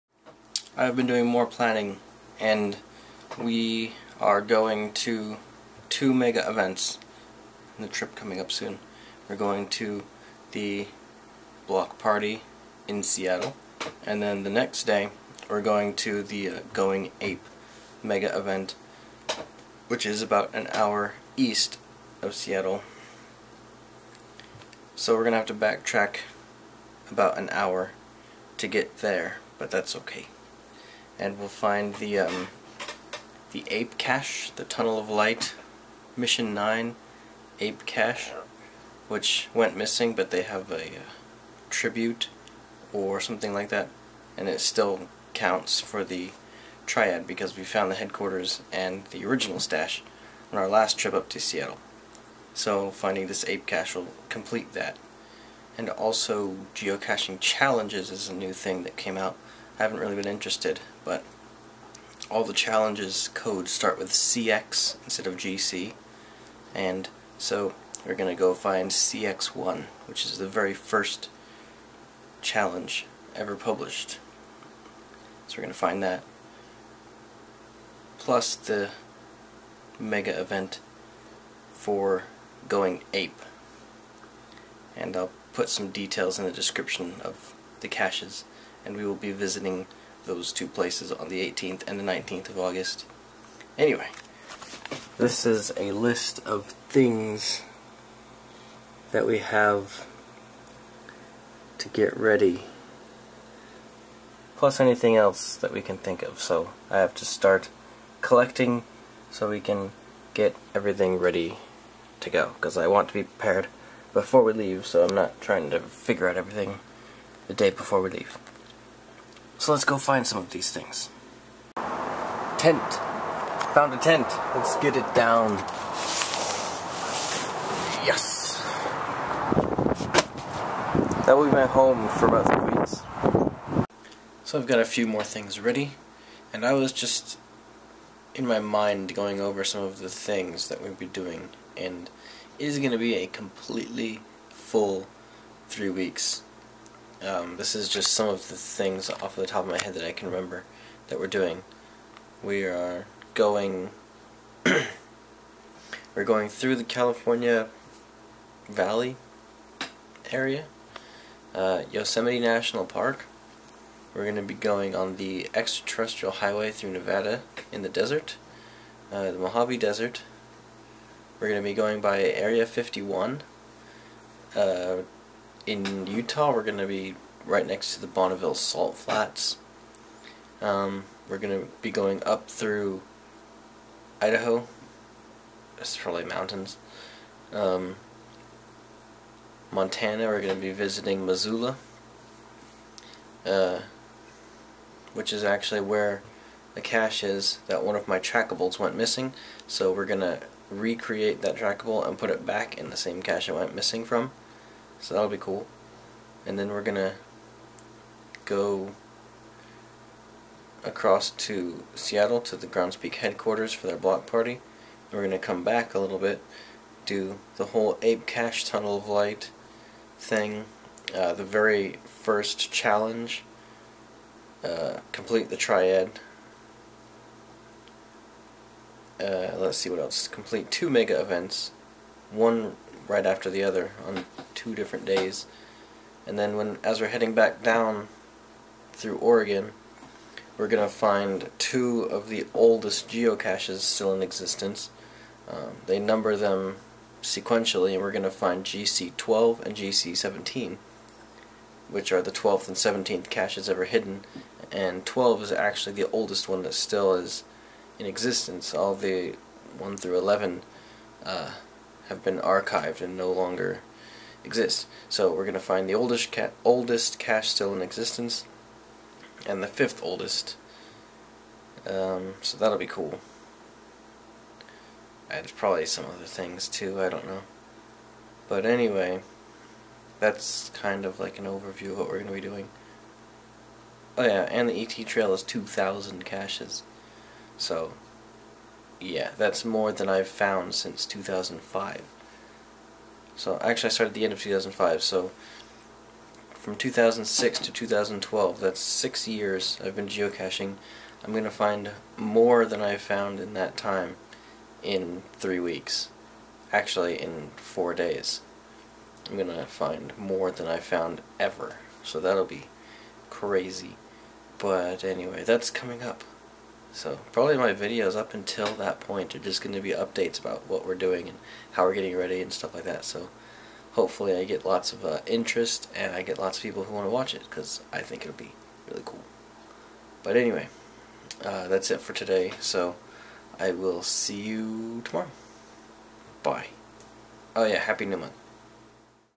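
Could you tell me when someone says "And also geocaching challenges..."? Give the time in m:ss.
0:55.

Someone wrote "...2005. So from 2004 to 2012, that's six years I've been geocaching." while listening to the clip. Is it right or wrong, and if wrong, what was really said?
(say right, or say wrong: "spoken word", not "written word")
wrong: "2006", not "2004".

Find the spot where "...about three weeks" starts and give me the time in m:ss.
2:12.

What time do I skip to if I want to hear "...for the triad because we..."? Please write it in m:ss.
0:45.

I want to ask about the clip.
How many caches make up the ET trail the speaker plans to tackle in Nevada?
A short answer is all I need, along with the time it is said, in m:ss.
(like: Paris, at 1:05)
2,000, at 4:45.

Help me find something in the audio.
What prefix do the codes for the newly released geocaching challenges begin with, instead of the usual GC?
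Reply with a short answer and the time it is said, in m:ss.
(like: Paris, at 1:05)
CX, at 1:04.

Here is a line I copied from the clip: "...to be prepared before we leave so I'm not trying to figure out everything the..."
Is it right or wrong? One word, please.
right.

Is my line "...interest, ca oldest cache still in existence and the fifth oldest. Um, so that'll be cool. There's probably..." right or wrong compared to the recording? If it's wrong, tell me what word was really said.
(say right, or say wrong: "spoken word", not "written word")
wrong: "oldest", not "interest".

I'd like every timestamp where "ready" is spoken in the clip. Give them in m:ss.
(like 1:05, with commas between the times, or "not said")
1:42, 1:51, 2:15, 5:22.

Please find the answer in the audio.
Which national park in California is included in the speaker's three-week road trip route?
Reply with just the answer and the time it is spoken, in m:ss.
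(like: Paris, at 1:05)
Yosemite, at 2:41.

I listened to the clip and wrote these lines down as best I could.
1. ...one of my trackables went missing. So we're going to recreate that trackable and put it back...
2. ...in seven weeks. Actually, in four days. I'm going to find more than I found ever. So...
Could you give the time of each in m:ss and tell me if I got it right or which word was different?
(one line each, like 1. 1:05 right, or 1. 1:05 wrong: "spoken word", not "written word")
1. 3:17 right
2. 5:04 wrong: "three", not "seven".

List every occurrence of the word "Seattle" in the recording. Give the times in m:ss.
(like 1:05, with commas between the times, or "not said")
0:13, 0:22, 0:51, 3:31.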